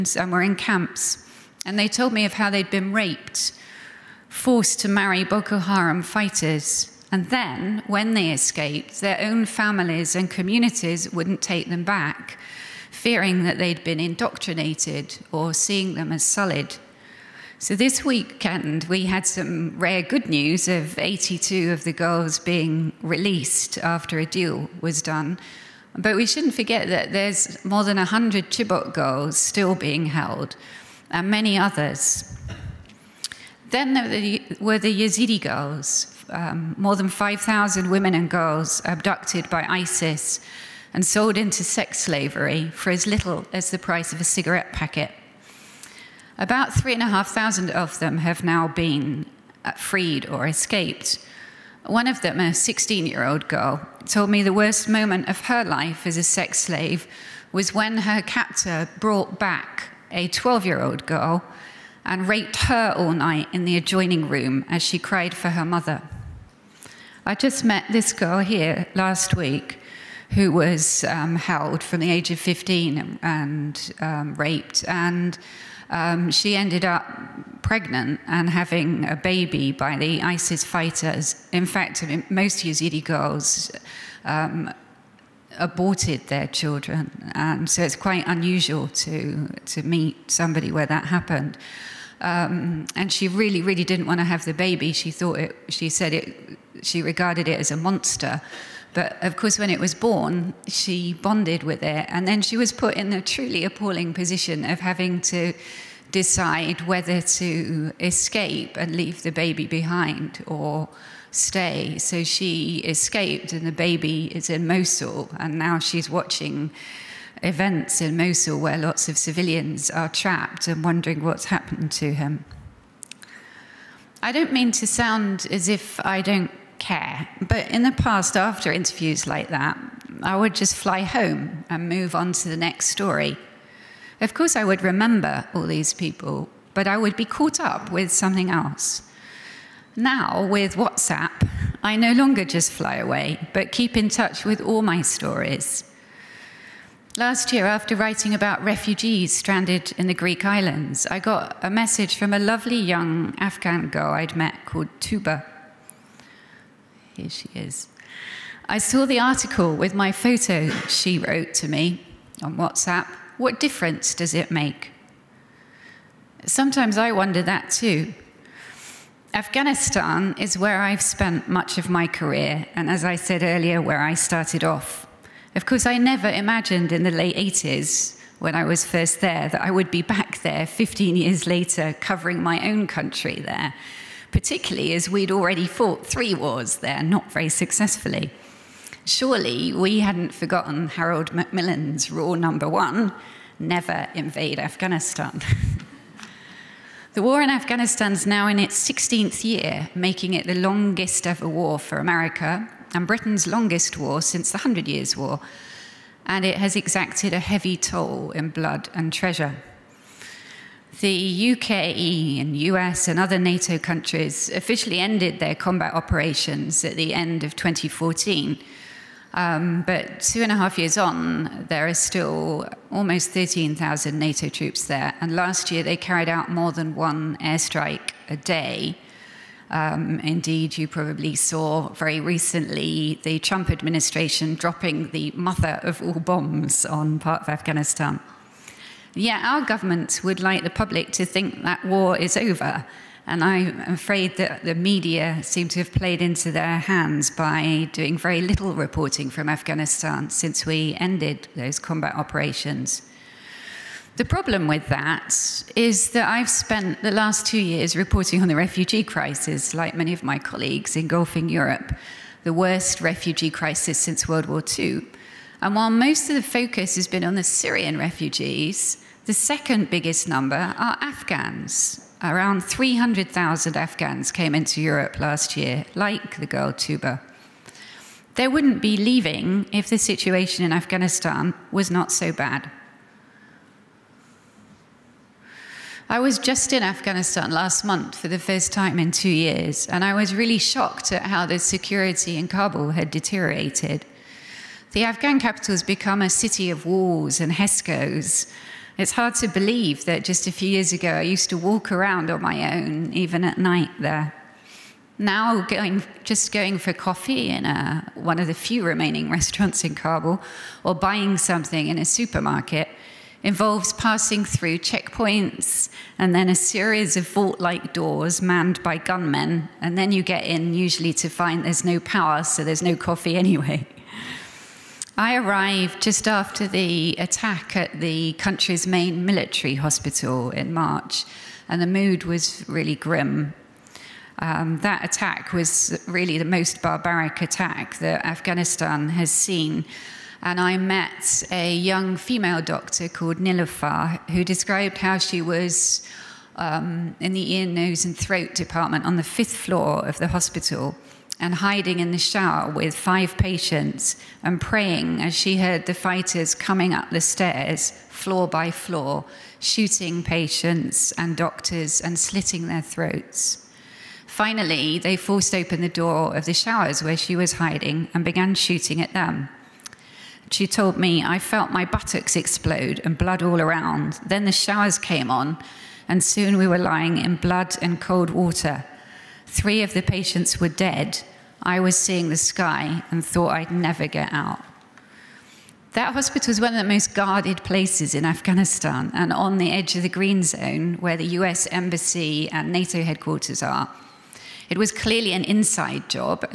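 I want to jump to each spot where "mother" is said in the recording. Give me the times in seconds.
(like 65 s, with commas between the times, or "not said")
65 s, 235 s.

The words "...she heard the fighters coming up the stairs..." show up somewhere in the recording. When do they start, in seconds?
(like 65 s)
355 s.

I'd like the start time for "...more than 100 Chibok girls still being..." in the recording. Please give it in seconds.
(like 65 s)
27 s.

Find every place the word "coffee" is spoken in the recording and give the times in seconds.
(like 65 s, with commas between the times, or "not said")
306 s, 322 s.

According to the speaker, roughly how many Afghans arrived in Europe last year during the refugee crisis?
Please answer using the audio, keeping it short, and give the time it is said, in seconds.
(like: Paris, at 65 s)
300,000, at 272 s.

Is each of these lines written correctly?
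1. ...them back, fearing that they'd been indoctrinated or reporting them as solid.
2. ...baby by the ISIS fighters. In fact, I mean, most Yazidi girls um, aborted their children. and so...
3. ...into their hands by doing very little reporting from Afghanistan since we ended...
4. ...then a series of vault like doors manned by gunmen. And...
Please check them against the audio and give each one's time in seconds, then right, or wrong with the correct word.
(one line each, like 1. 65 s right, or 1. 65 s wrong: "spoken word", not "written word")
1. 11 s wrong: "seeing", not "reporting"
2. 79 s right
3. 246 s right
4. 316 s right.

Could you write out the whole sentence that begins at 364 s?
Finally, they forced open the door of the showers where she was hiding and began shooting at them.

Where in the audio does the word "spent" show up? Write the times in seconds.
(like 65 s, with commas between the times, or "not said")
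171 s, 256 s.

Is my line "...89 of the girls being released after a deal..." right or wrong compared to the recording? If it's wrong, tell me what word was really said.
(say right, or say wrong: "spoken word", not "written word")
wrong: "82", not "89".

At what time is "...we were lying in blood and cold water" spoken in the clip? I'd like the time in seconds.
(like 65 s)
376 s.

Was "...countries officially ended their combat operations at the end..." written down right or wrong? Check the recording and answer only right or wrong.
right.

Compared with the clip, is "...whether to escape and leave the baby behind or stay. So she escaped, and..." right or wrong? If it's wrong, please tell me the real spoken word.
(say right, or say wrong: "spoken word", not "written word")
right.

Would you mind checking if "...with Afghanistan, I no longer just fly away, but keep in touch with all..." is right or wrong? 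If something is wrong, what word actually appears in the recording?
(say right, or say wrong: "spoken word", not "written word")
wrong: "WhatsApp", not "Afghanistan".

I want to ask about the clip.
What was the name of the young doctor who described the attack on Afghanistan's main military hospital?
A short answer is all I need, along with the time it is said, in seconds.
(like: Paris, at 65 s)
Nilofar, at 343 s.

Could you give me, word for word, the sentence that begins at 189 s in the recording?
Surely we hadn't forgotten Harold Macmillan's rule number one never invade Afghanistan.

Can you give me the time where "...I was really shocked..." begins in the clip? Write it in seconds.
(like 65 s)
290 s.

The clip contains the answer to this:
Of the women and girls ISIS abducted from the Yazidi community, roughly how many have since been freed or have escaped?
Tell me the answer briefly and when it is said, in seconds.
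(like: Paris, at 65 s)
3,500, at 46 s.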